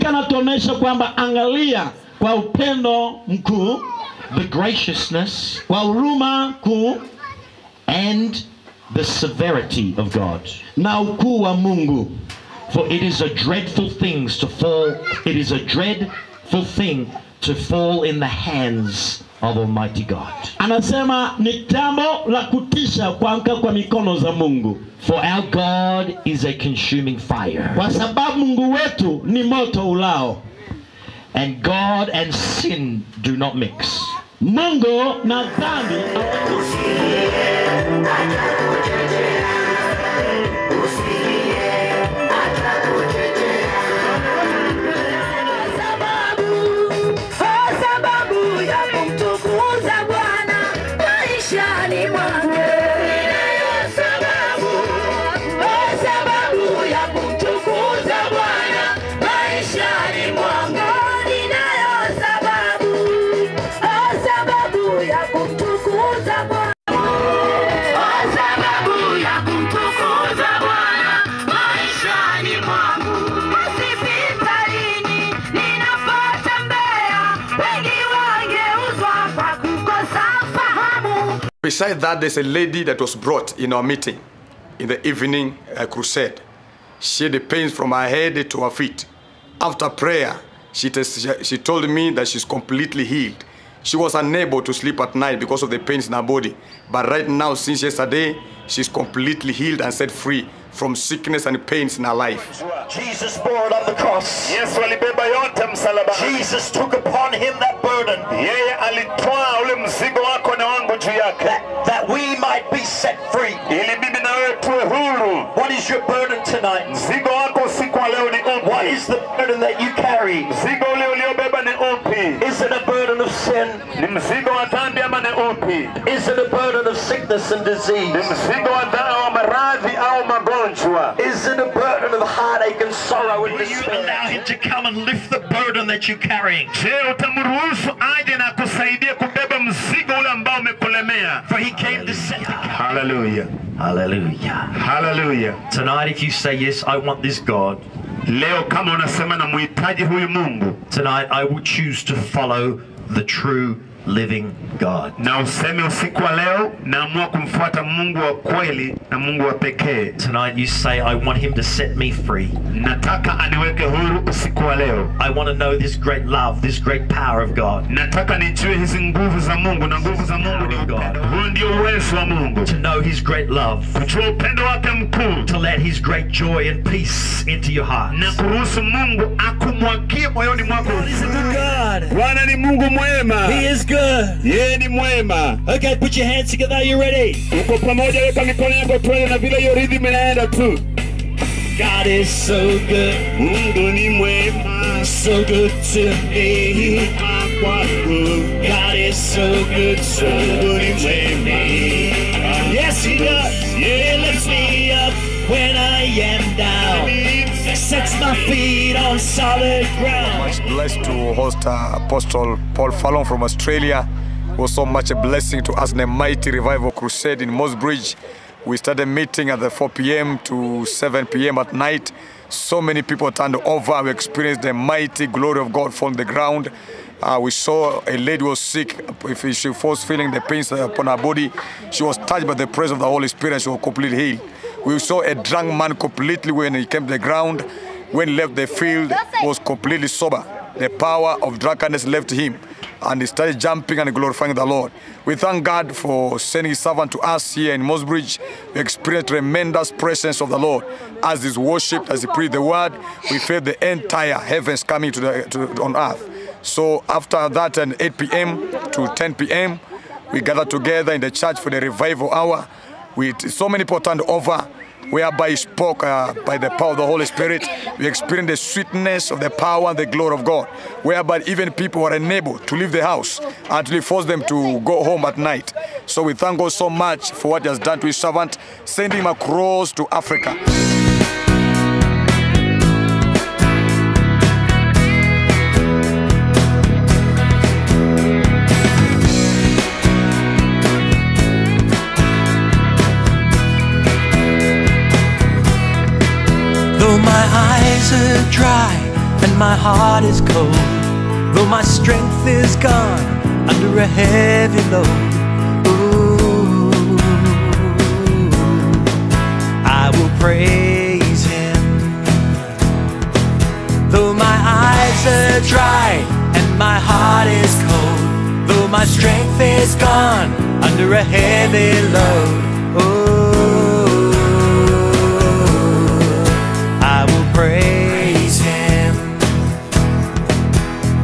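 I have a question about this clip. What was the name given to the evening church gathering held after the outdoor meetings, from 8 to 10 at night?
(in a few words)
Revival hour.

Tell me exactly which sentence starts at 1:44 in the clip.
Yes, Jesus took upon him burden, yeye alitwaa ule mzigo wako na wangu juu yake, that, we might be set free.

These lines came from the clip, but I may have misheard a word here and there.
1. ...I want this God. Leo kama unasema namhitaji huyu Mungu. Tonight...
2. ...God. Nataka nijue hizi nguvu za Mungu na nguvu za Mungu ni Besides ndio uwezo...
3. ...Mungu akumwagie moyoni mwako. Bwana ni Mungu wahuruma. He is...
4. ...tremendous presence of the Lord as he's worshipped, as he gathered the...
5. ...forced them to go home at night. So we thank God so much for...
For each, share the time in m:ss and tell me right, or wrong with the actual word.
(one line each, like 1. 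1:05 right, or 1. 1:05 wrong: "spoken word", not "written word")
1. 2:26 right
2. 2:47 wrong: "Huo", not "Besides"
3. 2:58 wrong: "mwema", not "wahuruma"
4. 4:09 wrong: "preached", not "gathered"
5. 4:34 right.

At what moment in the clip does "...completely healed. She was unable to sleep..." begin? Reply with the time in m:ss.
1:32.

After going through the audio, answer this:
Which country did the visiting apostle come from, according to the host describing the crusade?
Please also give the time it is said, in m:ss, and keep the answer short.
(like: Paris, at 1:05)
Australia, at 3:33.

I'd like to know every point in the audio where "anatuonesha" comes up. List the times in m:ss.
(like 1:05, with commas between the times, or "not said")
0:00.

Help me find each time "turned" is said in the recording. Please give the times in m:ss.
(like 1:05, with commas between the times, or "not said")
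3:43, 4:24.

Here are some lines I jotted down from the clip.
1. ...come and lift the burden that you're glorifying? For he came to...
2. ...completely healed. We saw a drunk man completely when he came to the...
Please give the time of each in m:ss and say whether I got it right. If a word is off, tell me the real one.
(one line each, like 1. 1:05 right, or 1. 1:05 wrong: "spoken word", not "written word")
1. 2:14 wrong: "carrying", not "glorifying"
2. 3:53 right.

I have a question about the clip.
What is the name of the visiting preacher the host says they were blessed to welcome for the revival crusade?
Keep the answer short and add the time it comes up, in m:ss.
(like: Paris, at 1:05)
Paul Furlong, at 3:32.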